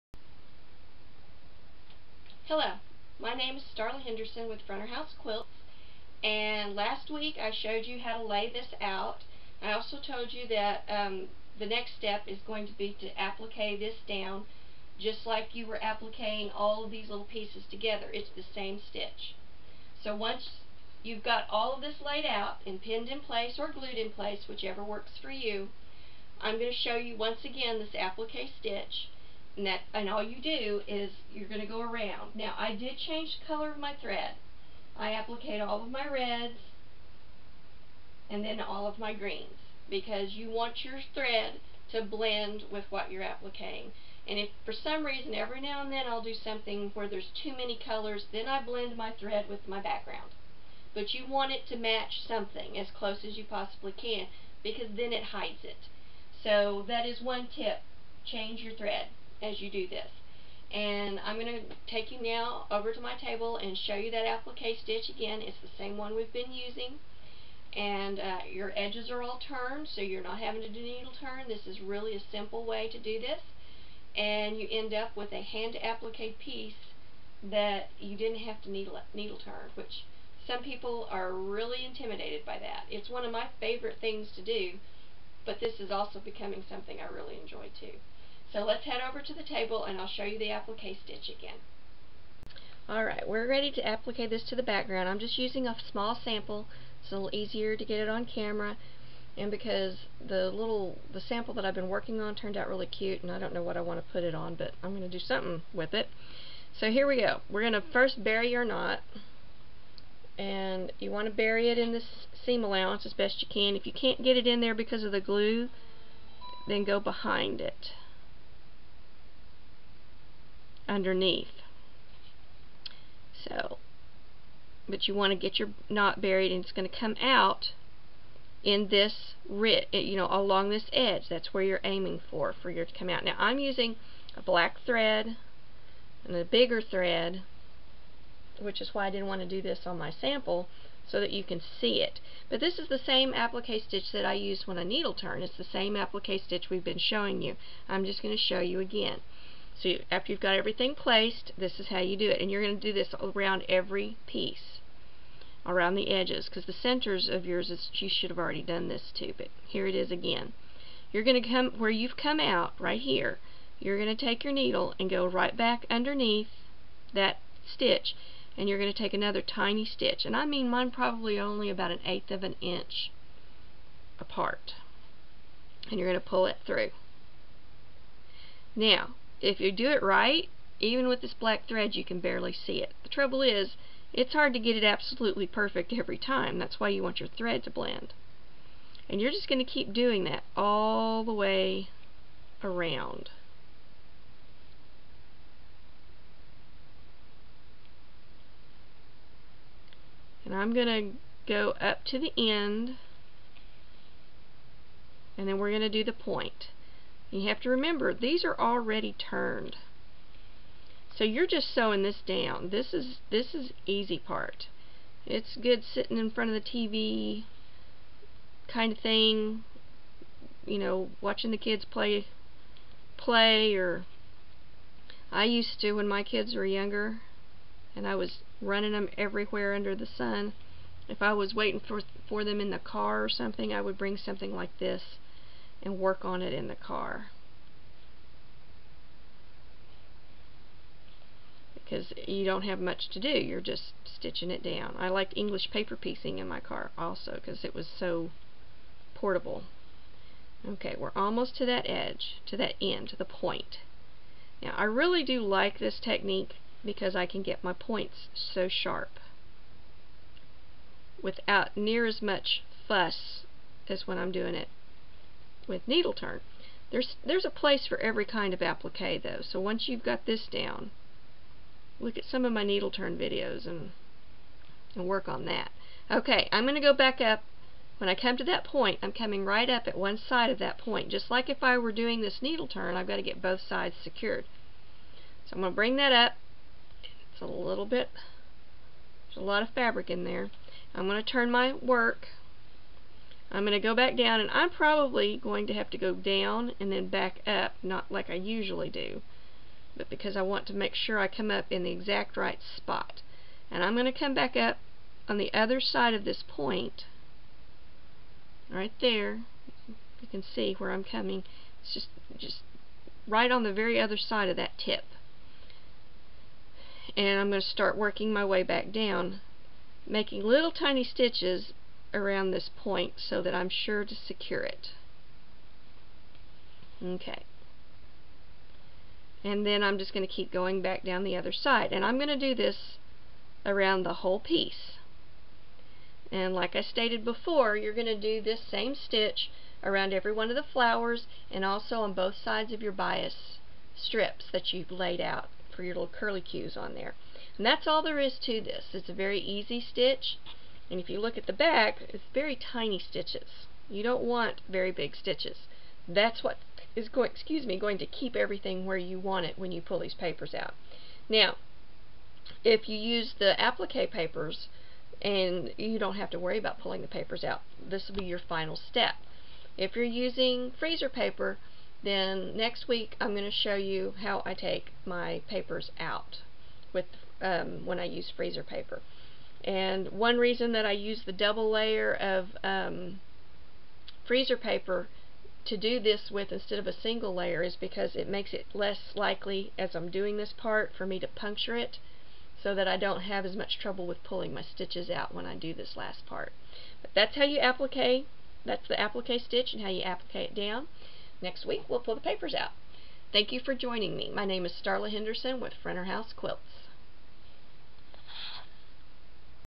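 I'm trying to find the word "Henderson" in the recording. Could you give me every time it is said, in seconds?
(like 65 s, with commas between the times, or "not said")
4 s, 405 s.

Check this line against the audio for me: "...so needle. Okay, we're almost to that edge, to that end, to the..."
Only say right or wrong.
wrong.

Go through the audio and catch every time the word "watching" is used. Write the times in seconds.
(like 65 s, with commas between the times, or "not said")
221 s.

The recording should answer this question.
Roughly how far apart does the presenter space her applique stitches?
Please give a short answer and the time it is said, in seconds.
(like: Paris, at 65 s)
an eighth of an inch, at 171 s.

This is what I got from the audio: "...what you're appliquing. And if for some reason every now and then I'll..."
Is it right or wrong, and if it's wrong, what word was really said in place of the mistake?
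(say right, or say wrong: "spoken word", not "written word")
right.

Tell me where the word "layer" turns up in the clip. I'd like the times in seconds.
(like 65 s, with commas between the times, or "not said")
381 s, 387 s.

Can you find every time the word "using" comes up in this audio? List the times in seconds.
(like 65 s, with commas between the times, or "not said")
66 s, 95 s, 133 s, 370 s.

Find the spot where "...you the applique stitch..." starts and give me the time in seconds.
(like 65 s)
90 s.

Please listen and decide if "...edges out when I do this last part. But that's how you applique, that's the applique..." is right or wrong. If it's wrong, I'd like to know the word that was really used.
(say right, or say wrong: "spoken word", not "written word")
wrong: "stitches", not "edges".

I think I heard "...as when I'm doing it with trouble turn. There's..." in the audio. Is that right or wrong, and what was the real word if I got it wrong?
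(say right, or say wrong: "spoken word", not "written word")
wrong: "needle", not "trouble".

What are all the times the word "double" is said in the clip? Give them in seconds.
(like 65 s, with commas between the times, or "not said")
381 s.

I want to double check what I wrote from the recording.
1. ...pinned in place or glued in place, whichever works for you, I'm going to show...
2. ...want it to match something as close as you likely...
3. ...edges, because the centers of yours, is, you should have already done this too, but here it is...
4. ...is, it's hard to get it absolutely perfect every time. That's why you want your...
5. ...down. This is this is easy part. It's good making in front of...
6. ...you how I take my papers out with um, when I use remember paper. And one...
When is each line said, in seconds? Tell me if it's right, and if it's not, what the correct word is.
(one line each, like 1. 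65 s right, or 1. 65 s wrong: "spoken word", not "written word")
1. 22 s right
2. 51 s wrong: "possibly", not "likely"
3. 156 s right
4. 183 s right
5. 212 s wrong: "sitting", not "making"
6. 373 s wrong: "freezer", not "remember".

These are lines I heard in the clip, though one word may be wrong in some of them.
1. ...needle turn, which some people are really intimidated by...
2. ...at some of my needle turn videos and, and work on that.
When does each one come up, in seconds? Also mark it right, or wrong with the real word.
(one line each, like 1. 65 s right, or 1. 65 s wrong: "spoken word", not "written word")
1. 79 s right
2. 272 s right.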